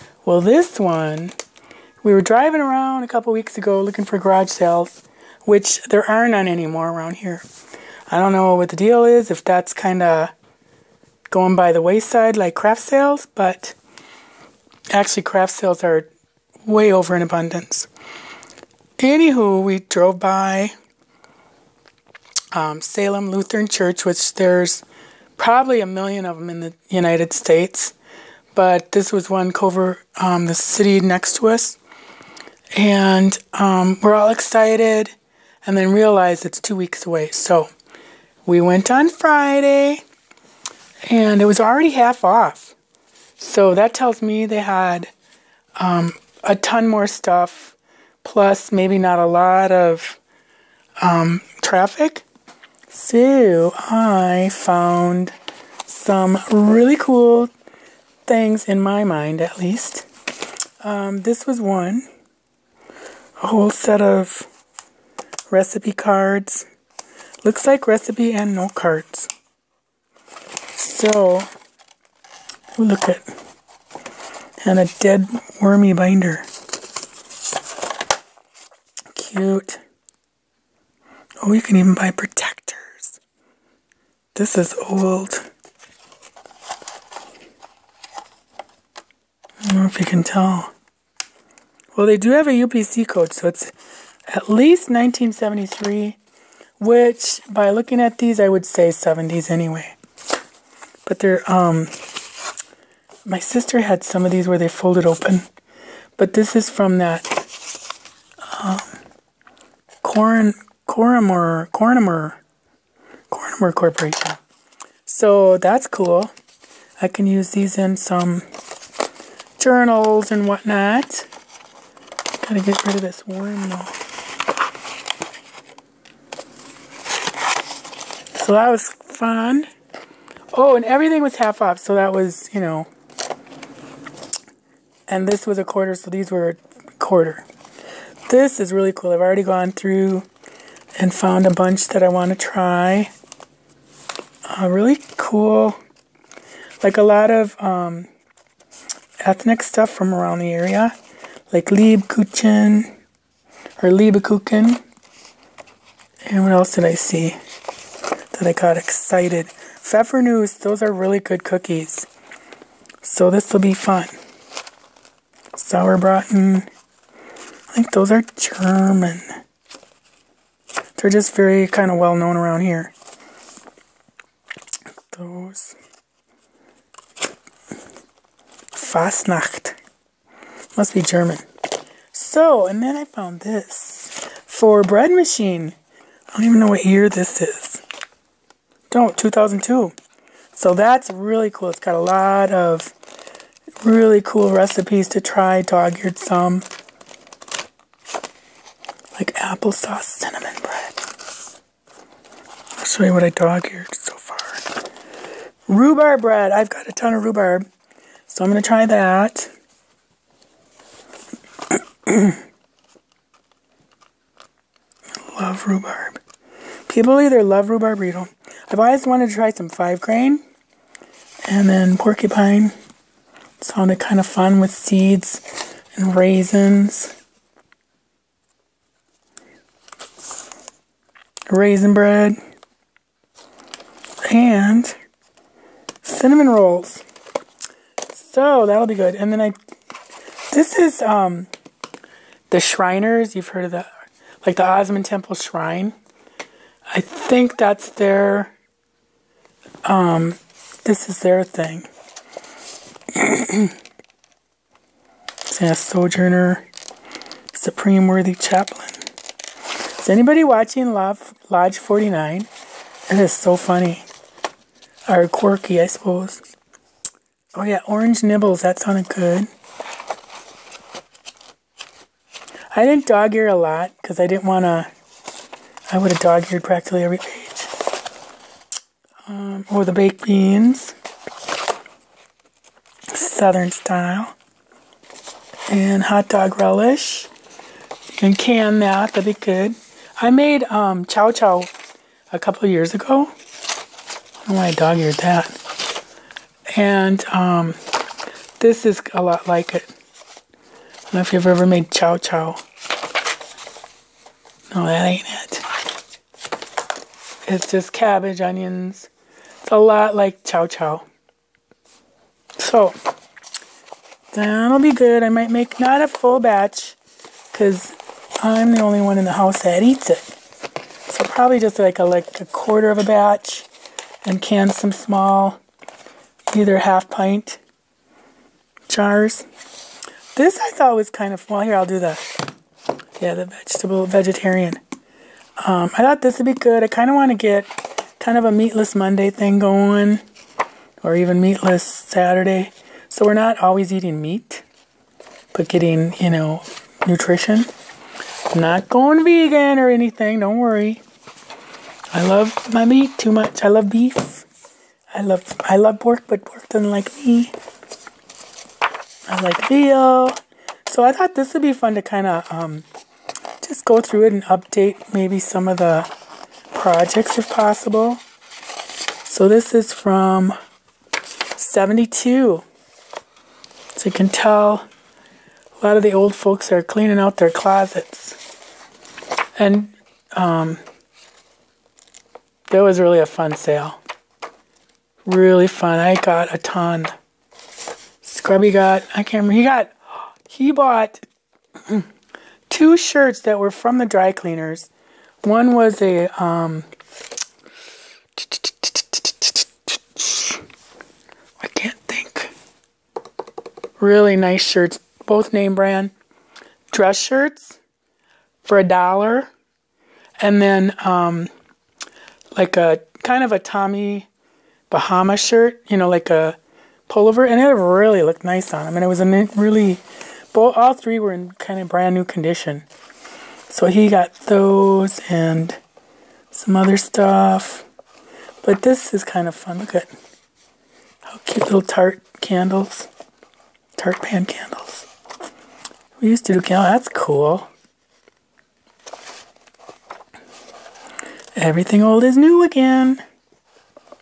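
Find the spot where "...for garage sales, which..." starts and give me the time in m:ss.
0:04.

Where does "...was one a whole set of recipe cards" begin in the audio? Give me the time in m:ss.
1:01.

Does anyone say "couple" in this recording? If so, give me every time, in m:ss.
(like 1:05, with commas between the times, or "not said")
0:03, 4:52.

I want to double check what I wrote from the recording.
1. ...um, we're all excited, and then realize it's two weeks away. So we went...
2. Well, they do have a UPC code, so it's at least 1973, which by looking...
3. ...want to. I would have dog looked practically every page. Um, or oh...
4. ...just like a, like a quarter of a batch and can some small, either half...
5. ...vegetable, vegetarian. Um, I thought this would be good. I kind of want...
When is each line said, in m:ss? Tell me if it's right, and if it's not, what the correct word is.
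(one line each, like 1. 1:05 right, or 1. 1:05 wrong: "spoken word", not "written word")
1. 0:33 right
2. 1:31 right
3. 4:34 wrong: "eared", not "looked"
4. 5:21 right
5. 5:33 right.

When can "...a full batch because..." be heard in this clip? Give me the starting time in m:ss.
5:16.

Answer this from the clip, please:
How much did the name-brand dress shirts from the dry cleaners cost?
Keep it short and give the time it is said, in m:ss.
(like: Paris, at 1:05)
a dollar, at 6:48.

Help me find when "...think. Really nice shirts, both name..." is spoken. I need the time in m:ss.
6:42.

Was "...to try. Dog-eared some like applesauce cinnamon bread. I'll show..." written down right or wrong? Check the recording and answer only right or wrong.
right.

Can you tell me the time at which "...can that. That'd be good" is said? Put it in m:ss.
4:48.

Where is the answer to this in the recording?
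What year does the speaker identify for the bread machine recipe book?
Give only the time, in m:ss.
3:09.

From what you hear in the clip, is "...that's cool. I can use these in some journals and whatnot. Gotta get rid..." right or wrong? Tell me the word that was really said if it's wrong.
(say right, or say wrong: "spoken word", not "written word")
right.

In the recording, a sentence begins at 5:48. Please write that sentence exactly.
Not going vegan or anything, don't worry.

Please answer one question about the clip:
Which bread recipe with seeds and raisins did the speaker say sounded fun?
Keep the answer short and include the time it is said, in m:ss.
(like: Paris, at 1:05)
porcupine, at 3:41.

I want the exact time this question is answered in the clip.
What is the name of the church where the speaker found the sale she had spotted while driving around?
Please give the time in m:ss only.
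0:22.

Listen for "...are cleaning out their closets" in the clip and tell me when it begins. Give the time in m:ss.
6:16.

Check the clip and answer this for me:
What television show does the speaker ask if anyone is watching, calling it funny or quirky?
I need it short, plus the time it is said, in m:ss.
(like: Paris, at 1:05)
Lodge 49, at 4:20.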